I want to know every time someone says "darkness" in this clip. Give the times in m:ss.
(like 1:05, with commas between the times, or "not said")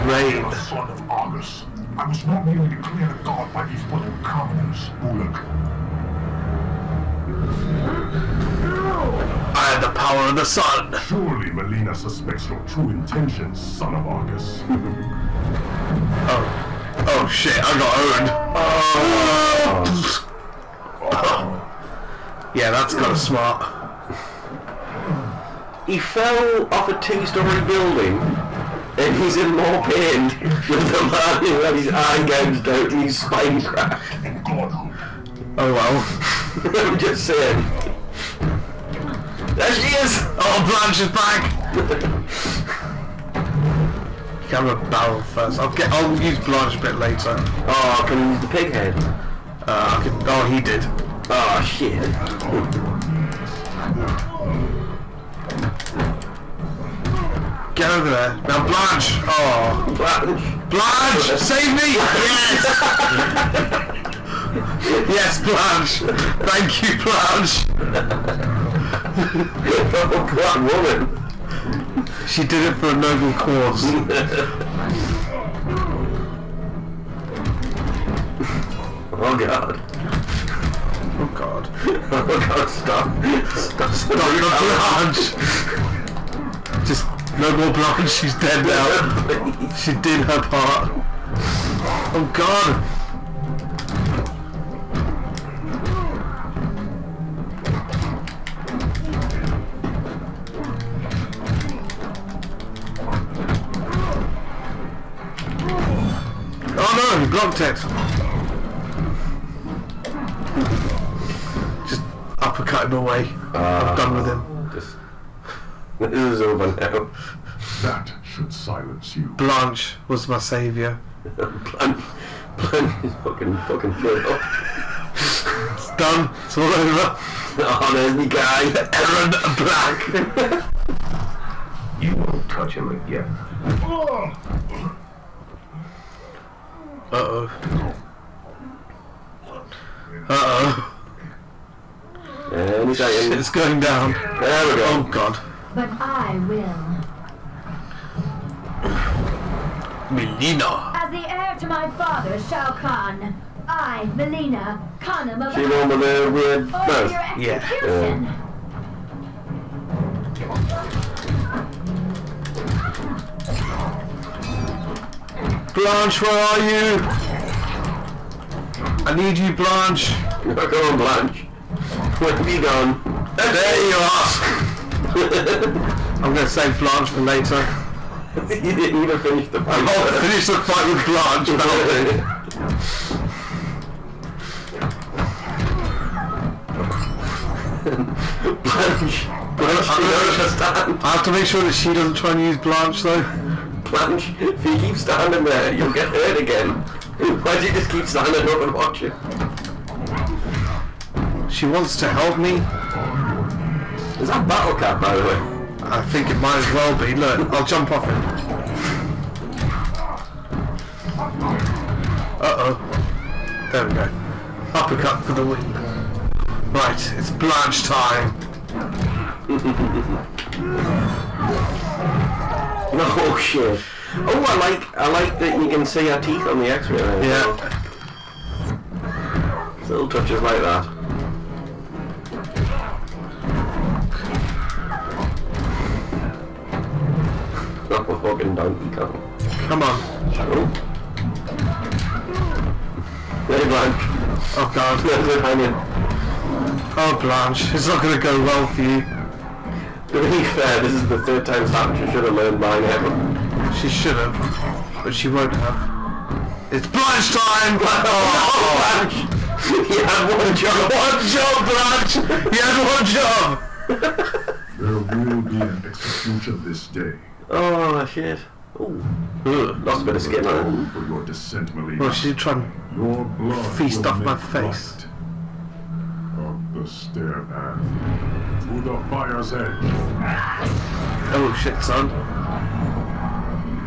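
not said.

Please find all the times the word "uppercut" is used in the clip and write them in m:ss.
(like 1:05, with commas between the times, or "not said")
1:52, 3:34.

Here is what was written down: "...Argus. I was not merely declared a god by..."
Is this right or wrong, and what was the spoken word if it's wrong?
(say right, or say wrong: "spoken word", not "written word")
right.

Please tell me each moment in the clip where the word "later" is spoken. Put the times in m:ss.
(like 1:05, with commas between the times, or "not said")
0:46, 2:57.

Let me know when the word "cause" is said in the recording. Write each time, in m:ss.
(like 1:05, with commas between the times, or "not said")
1:13.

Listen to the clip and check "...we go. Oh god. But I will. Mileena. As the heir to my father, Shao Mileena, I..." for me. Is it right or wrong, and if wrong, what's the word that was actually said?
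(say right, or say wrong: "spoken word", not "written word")
wrong: "Kahn", not "Mileena".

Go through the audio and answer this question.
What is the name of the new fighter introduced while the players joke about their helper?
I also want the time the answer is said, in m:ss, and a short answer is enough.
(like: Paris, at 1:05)
Erron Black, at 2:08.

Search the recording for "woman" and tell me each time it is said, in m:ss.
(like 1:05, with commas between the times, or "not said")
1:10.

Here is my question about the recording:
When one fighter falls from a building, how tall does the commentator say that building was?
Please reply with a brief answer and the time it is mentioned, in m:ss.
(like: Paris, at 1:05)
two story, at 0:26.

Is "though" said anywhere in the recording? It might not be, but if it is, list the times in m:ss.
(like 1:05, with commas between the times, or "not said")
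3:13.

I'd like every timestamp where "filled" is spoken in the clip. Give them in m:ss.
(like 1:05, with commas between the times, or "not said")
2:03.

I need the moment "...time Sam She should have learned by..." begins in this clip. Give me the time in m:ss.
4:11.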